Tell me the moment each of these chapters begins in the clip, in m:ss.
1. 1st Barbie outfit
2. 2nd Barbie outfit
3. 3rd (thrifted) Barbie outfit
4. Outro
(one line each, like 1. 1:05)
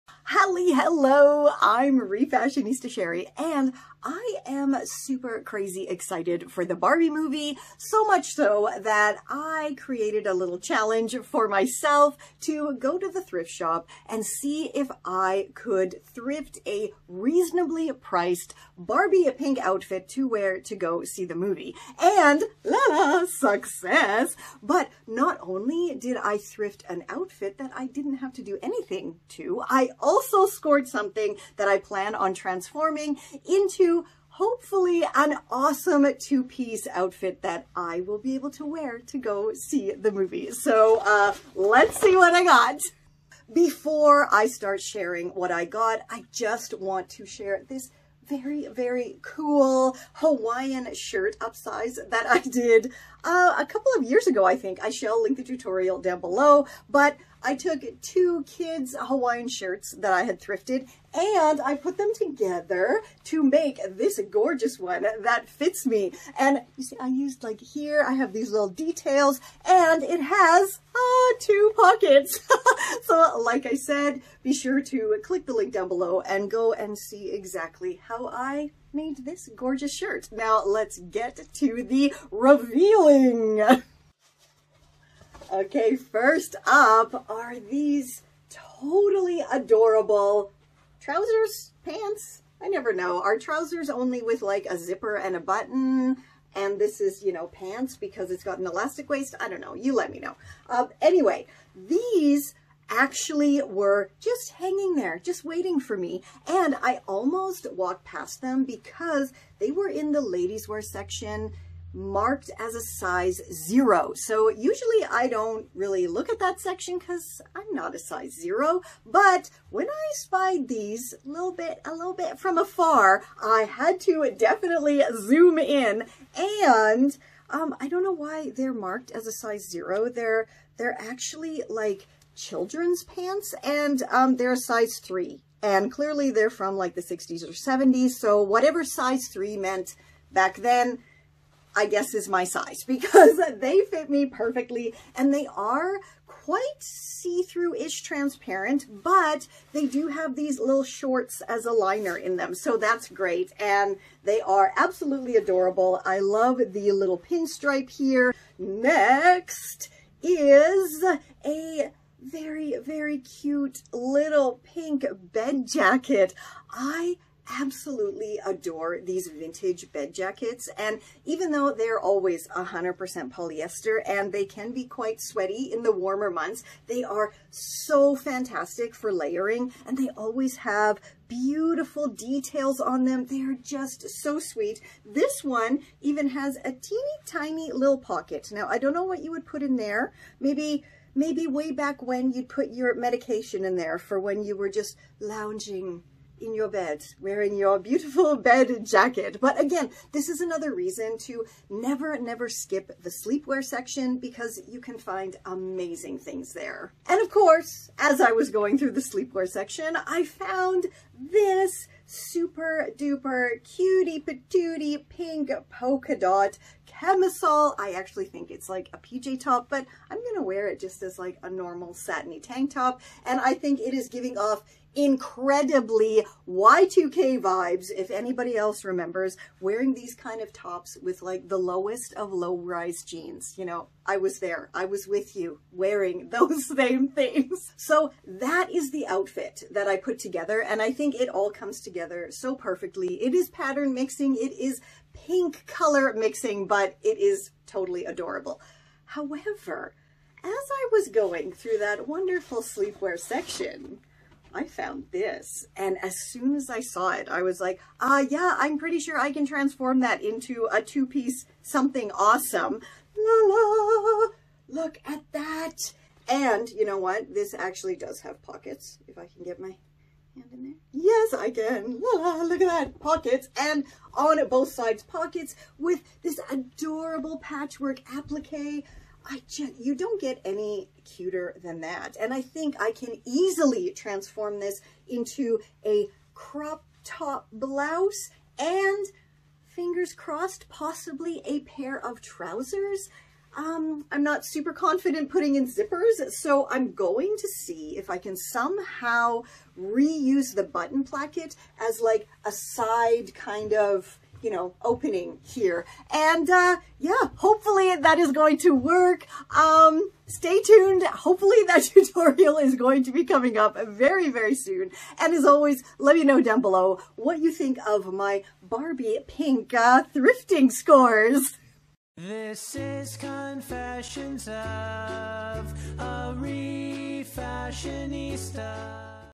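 1. 2:21
2. 3:08
3. 3:45
4. 5:22.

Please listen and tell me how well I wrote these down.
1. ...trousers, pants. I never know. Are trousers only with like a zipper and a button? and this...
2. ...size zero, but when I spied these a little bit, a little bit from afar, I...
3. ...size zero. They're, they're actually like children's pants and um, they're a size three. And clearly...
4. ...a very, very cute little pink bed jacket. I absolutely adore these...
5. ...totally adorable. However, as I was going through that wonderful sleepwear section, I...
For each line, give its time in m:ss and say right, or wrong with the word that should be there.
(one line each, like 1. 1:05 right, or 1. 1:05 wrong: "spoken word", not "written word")
1. 1:30 right
2. 1:57 right
3. 2:09 right
4. 2:41 right
5. 4:07 right.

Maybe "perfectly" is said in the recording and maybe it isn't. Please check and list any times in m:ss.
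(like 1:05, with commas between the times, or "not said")
2:24, 4:02.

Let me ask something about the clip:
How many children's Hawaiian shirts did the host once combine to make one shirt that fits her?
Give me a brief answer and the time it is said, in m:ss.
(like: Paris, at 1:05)
2, at 0:58.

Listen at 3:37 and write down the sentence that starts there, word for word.
I actually think it's like a PJ top, but I'm going to wear it just as like a normal satiny tank top.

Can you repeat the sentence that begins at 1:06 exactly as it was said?
And you see, I used like here, I have these little details and it has uh, two pockets.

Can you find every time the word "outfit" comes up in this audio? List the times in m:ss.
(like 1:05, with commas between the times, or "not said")
0:19, 0:27, 0:36, 3:59.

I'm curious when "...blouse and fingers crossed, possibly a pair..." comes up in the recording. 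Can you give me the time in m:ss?
4:47.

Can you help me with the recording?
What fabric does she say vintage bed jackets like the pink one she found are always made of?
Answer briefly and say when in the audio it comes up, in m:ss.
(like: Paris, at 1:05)
100% polyester, at 2:52.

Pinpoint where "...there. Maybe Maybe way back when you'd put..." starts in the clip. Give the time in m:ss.
3:09.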